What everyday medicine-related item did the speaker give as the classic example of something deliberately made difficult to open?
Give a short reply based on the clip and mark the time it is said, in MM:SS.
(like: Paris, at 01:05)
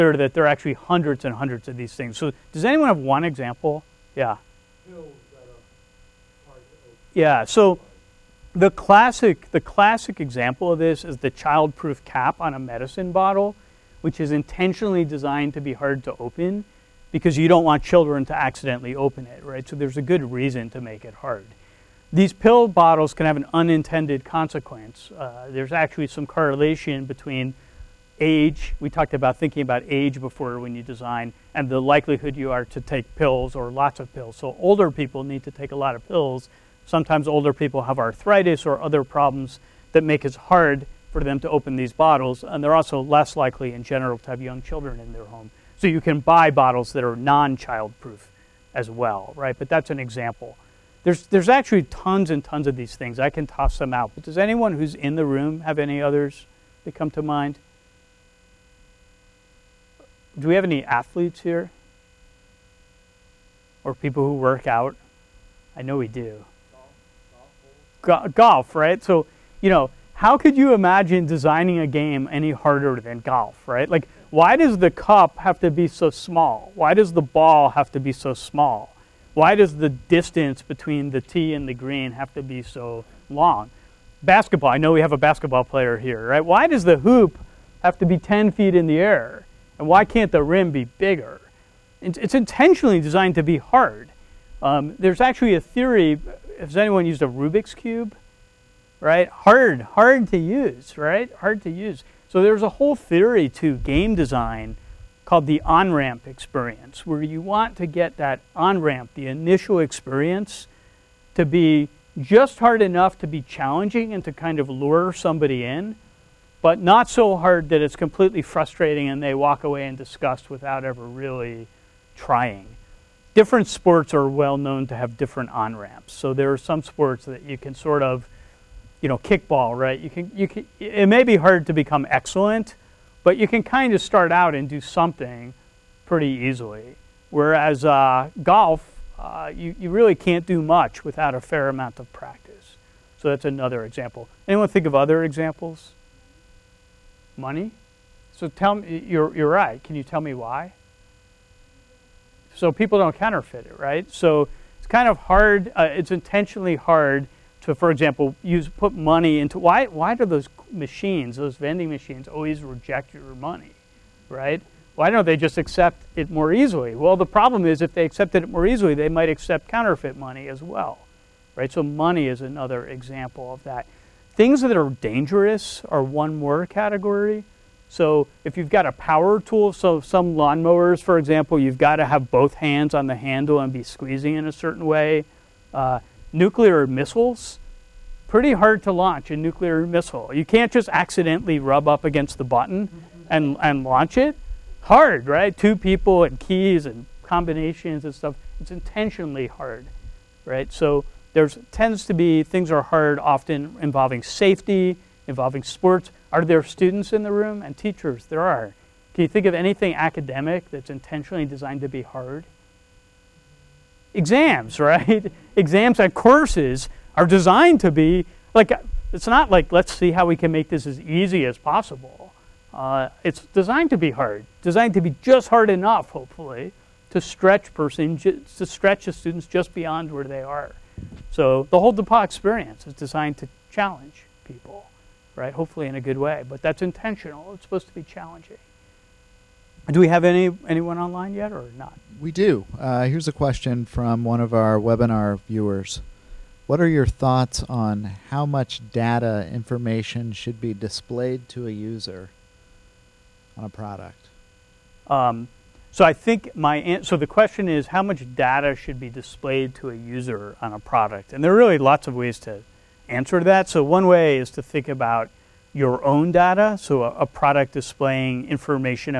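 childproof cap, at 00:11.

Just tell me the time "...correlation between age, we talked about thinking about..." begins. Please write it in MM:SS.
00:26.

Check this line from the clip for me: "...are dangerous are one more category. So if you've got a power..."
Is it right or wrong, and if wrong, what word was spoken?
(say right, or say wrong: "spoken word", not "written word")
right.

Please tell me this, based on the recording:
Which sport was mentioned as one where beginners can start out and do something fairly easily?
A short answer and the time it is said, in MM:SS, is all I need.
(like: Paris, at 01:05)
kickball, at 02:09.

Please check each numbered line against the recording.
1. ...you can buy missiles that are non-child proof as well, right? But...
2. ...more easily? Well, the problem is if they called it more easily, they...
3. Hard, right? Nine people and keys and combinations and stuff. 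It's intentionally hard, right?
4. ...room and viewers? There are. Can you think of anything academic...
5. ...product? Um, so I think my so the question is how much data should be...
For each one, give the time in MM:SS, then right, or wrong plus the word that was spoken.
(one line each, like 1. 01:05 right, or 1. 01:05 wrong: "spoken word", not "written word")
1. 00:45 wrong: "bottles", not "missiles"
2. 02:46 wrong: "accepted", not "called"
3. 03:14 wrong: "Two", not "Nine"
4. 03:27 wrong: "teachers", not "viewers"
5. 04:13 right.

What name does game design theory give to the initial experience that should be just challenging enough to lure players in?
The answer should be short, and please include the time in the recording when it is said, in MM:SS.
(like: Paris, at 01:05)
on ramp experience, at 01:45.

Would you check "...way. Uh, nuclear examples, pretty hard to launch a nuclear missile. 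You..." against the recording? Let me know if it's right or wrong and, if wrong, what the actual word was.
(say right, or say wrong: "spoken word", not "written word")
wrong: "missiles", not "examples".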